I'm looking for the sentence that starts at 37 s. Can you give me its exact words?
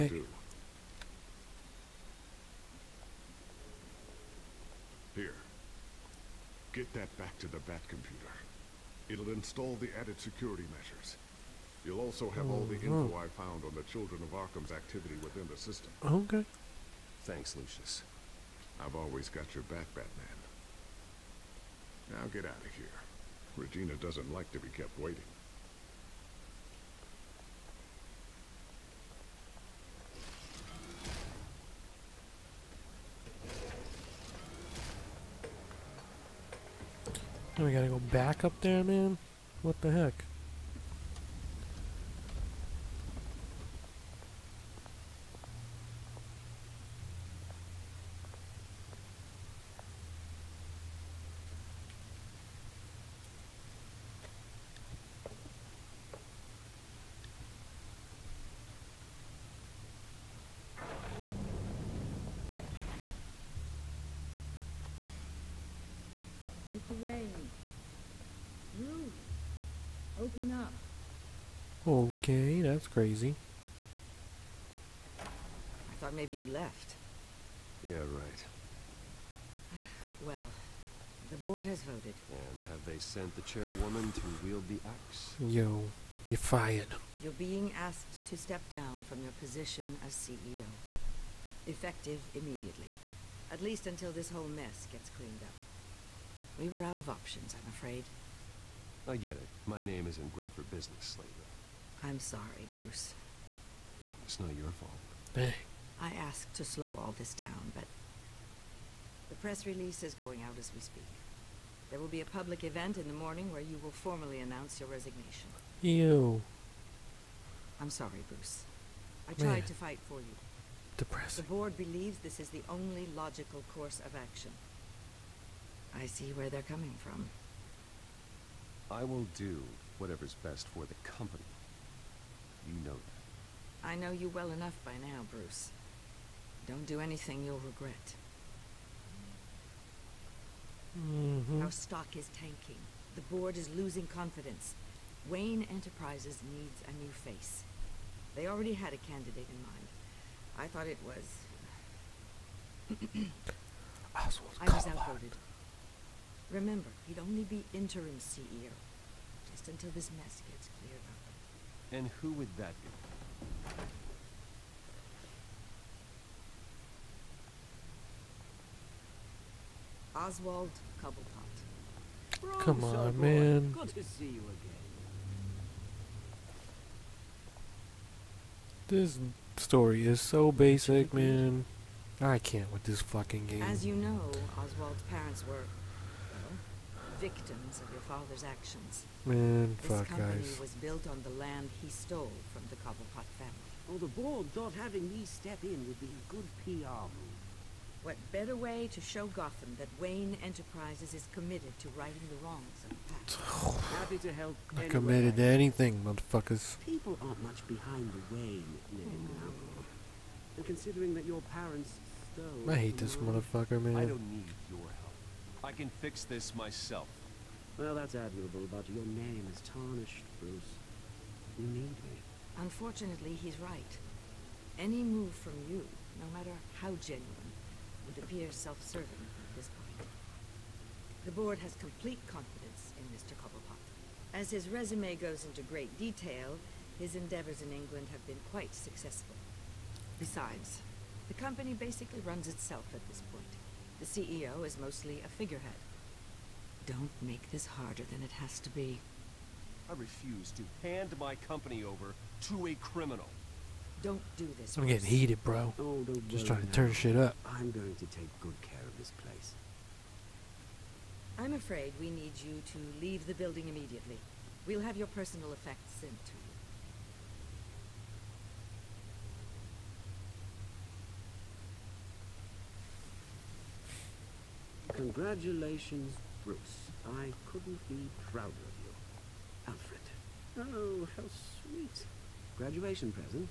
we gotta go back up there, man?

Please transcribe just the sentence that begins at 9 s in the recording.
It'll install the added security measures.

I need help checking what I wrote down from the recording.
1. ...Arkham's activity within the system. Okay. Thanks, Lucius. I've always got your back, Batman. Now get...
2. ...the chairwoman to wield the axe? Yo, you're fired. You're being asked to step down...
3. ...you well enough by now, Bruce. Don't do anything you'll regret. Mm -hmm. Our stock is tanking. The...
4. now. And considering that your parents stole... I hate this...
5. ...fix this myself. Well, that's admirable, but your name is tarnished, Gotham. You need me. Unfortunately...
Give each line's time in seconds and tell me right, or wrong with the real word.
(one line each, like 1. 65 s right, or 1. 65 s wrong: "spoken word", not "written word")
1. 14 s right
2. 83 s right
3. 134 s right
4. 209 s right
5. 216 s wrong: "Bruce", not "Gotham".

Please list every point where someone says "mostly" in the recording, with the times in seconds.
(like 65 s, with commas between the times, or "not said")
244 s.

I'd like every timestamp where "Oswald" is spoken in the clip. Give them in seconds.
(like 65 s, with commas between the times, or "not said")
170 s, 184 s.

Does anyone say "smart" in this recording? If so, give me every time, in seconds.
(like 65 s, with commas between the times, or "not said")
not said.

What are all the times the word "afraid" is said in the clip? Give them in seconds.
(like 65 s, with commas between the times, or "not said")
97 s, 261 s.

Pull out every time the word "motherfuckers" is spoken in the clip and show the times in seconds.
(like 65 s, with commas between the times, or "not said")
206 s, 213 s.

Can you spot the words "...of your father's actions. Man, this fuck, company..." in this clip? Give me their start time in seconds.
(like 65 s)
187 s.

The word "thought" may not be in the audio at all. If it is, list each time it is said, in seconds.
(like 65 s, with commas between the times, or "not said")
76 s, 150 s, 194 s.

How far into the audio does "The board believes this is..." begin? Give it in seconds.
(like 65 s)
121 s.